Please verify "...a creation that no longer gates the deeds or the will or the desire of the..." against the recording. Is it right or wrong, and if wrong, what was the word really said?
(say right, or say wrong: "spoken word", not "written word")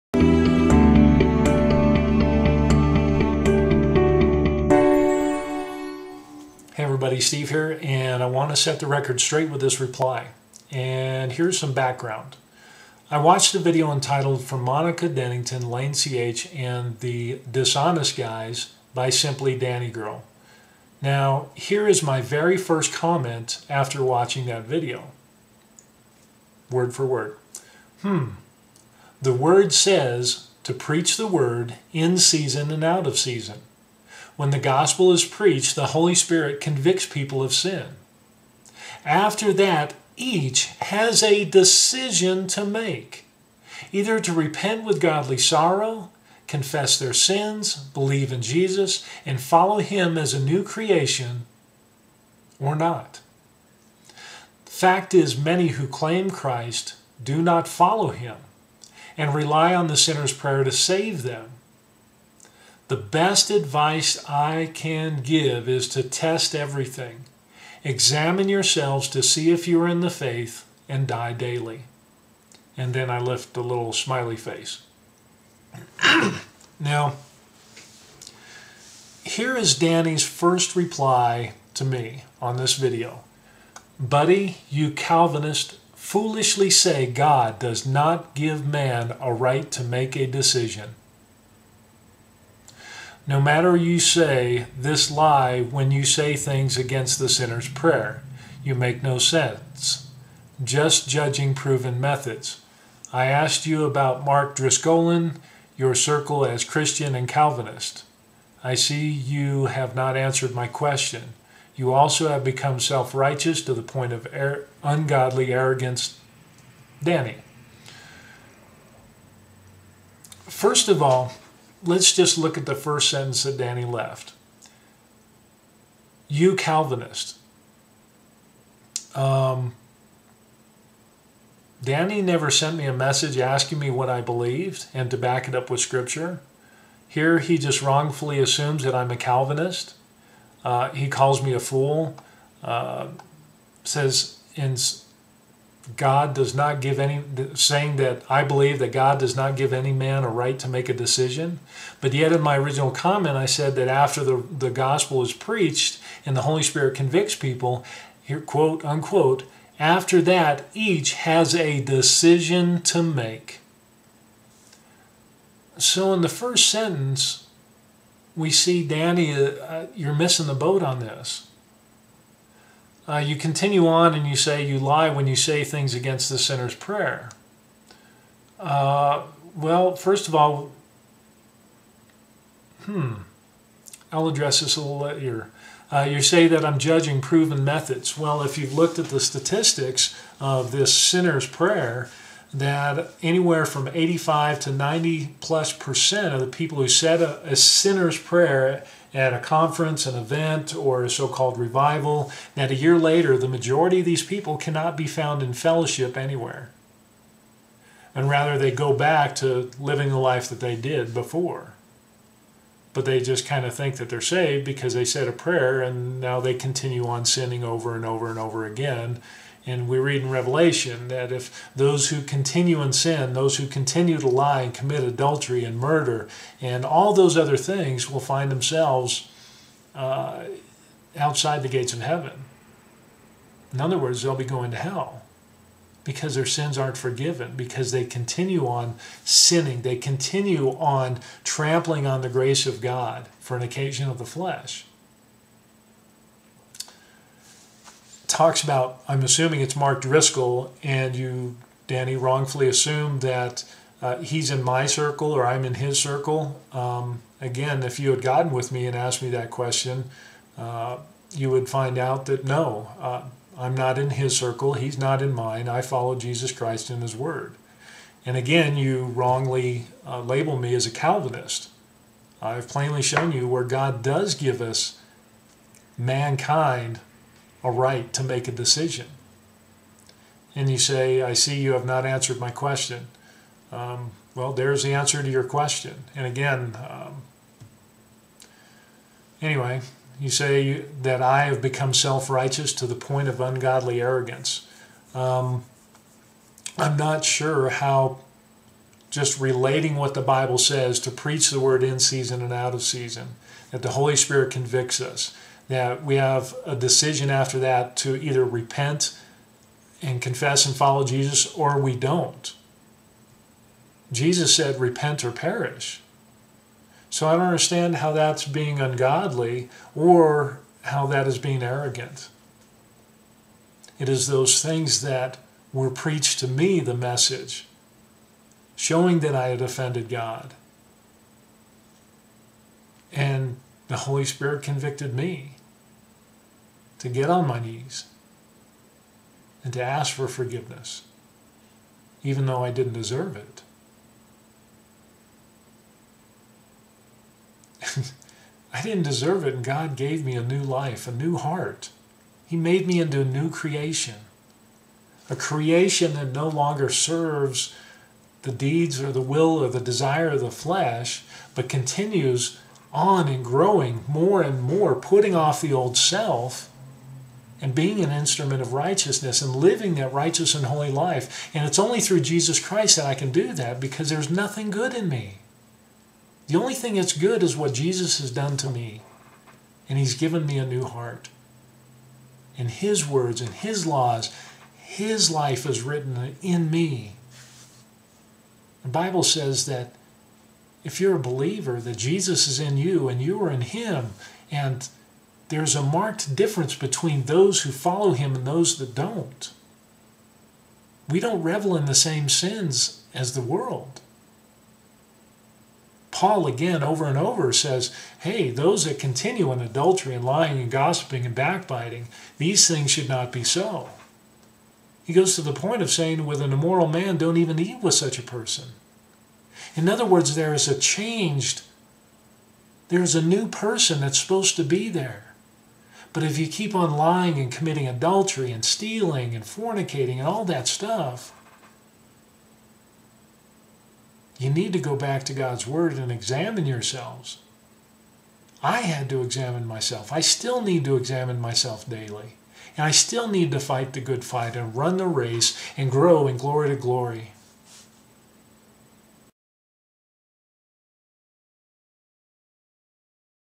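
wrong: "serves", not "gates".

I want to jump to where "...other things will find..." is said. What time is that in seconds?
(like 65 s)
227 s.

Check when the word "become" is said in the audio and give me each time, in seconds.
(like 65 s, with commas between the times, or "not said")
112 s, 291 s.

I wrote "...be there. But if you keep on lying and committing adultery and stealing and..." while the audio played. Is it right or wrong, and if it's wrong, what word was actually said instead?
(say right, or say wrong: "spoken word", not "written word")
right.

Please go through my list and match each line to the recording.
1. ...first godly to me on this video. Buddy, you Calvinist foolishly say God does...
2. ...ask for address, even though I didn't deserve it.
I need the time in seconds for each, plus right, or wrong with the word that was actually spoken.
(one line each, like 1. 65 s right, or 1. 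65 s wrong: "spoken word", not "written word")
1. 80 s wrong: "reply", not "godly"
2. 339 s wrong: "forgiveness", not "address".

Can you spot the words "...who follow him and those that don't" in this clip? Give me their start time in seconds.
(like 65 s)
397 s.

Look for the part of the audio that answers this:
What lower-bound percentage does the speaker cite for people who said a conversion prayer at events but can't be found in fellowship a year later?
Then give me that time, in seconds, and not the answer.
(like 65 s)
193 s.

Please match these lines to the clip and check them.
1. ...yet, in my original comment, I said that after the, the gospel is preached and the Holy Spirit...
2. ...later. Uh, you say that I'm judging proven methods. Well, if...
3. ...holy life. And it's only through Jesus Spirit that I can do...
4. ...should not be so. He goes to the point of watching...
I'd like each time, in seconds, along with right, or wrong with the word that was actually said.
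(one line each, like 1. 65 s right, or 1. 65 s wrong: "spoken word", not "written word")
1. 152 s right
2. 184 s right
3. 370 s wrong: "Christ", not "Spirit"
4. 412 s wrong: "saying", not "watching".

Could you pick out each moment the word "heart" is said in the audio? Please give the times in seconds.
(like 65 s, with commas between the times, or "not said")
351 s, 380 s.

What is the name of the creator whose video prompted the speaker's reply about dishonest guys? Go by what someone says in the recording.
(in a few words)
Simply Danny Girl.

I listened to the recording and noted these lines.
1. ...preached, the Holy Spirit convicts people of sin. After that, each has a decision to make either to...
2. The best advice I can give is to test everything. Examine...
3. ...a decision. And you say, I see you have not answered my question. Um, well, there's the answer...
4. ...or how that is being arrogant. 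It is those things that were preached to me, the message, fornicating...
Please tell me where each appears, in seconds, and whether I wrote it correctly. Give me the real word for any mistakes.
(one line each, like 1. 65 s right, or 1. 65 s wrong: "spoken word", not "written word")
1. 35 s right
2. 62 s right
3. 278 s right
4. 319 s wrong: "showing", not "fornicating".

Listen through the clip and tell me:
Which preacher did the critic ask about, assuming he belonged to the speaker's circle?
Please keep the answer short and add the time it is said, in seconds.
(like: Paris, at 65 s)
Mark Driscoll, at 104 s.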